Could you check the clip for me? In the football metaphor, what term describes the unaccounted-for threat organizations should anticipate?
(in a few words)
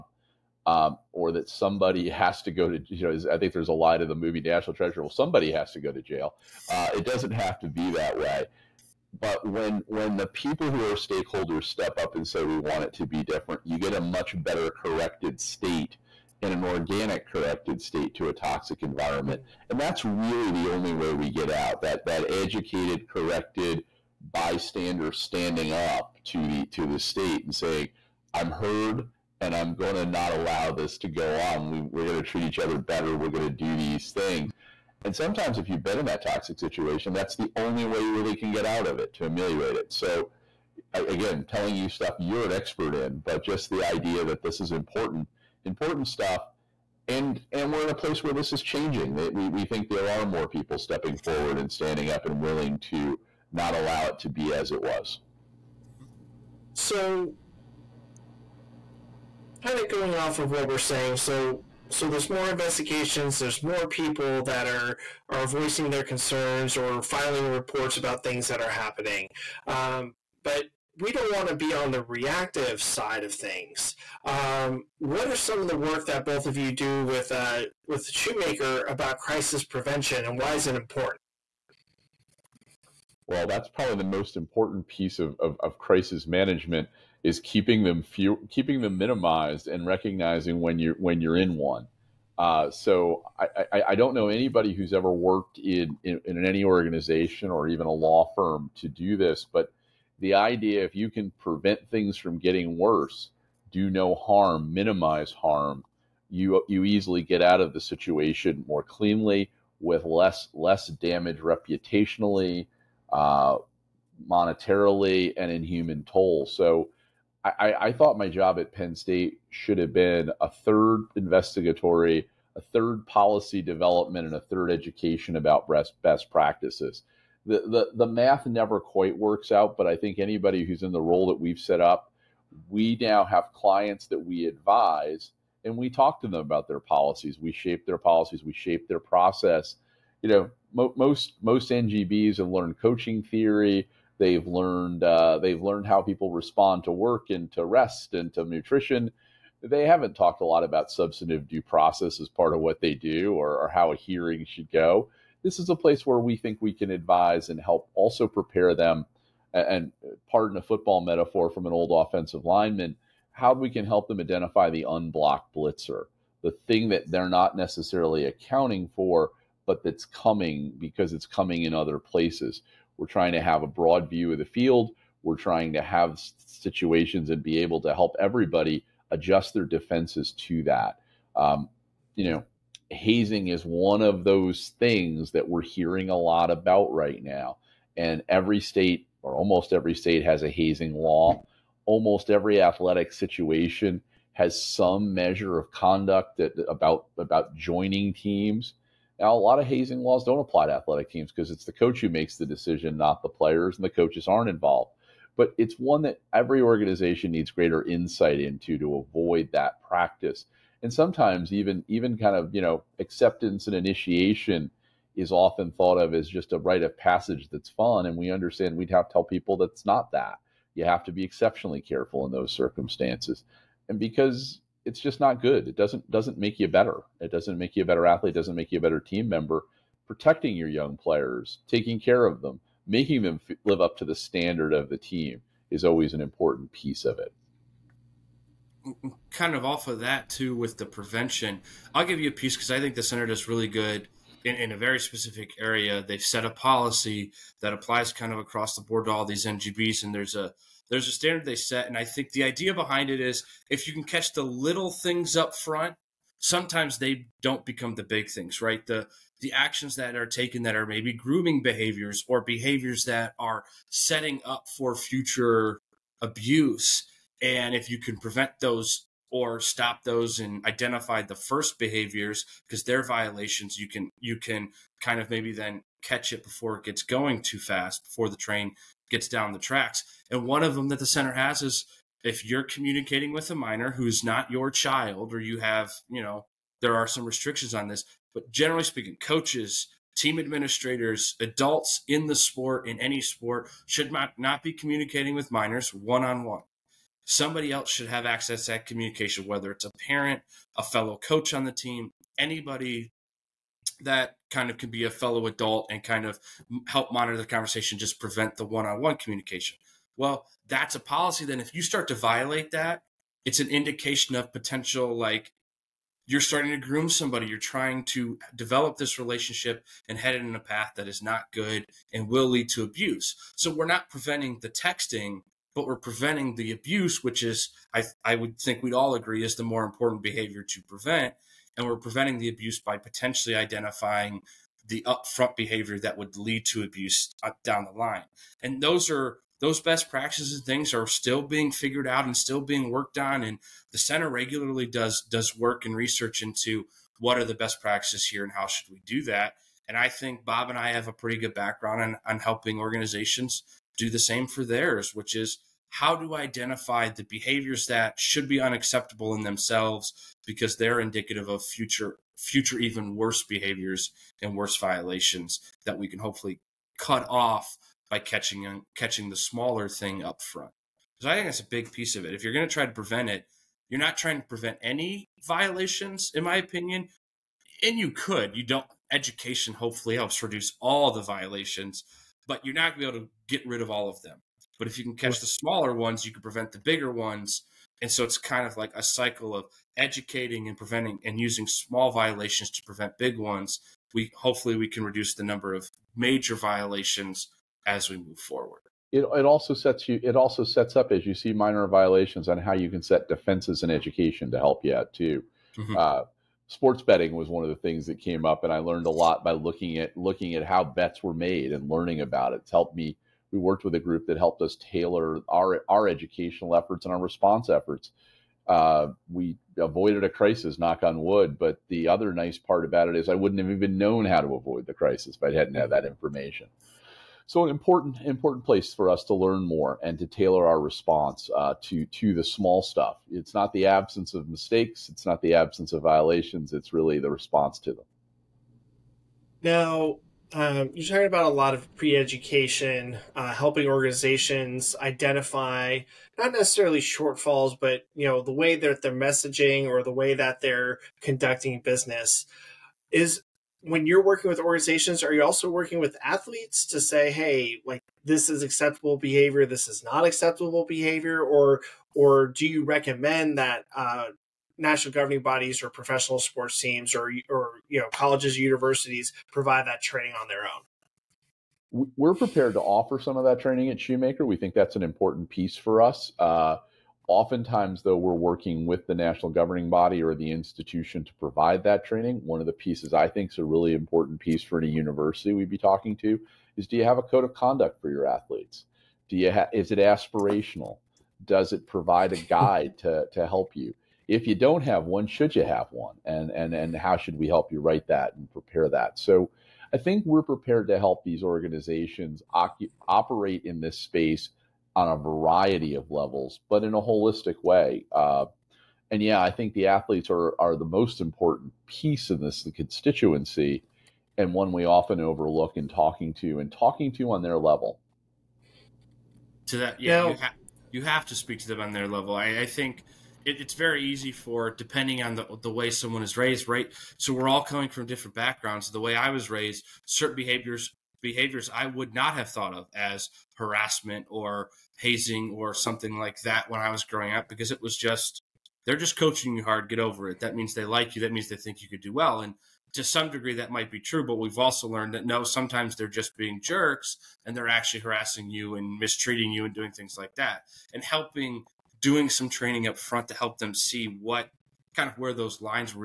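Unblocked blitzer.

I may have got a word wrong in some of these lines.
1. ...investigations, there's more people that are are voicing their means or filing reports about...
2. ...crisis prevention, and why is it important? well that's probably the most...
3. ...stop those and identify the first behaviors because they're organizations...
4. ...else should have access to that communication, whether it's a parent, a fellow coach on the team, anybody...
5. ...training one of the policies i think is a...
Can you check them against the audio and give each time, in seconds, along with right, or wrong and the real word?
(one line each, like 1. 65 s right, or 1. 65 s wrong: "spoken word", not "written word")
1. 62 s wrong: "concerns", not "means"
2. 79 s right
3. 269 s wrong: "violations", not "organizations"
4. 297 s right
5. 482 s wrong: "pieces", not "policies".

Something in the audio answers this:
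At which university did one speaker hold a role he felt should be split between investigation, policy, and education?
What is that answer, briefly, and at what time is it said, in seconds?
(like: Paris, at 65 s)
Penn State, at 118 s.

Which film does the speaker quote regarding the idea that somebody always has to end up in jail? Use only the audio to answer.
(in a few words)
National Treasure.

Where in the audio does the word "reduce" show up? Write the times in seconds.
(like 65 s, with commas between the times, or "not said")
380 s, 395 s.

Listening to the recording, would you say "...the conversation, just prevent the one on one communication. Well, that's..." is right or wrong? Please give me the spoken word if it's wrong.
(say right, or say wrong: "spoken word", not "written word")
right.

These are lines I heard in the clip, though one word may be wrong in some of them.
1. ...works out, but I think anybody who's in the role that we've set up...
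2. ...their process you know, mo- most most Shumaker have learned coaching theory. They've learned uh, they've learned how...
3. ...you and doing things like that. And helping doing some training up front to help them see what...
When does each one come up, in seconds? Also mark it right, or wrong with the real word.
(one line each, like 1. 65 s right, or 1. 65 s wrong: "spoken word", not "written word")
1. 129 s right
2. 138 s wrong: "NGBs", not "Shumaker"
3. 549 s right.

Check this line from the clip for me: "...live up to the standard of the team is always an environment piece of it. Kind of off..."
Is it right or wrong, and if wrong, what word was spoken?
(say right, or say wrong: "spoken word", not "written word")
wrong: "important", not "environment".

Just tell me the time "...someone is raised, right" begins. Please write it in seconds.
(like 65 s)
525 s.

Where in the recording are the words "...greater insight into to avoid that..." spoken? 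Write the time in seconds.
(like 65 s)
207 s.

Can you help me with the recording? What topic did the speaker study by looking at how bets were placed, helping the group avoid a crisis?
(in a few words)
Sports betting.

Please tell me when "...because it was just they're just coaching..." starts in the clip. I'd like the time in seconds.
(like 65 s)
537 s.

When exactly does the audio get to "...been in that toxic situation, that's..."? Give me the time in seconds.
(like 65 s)
35 s.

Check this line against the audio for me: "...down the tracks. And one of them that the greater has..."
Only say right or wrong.
wrong.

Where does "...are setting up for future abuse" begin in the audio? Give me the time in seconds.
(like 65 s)
263 s.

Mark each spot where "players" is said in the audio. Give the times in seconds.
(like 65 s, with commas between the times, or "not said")
203 s, 230 s.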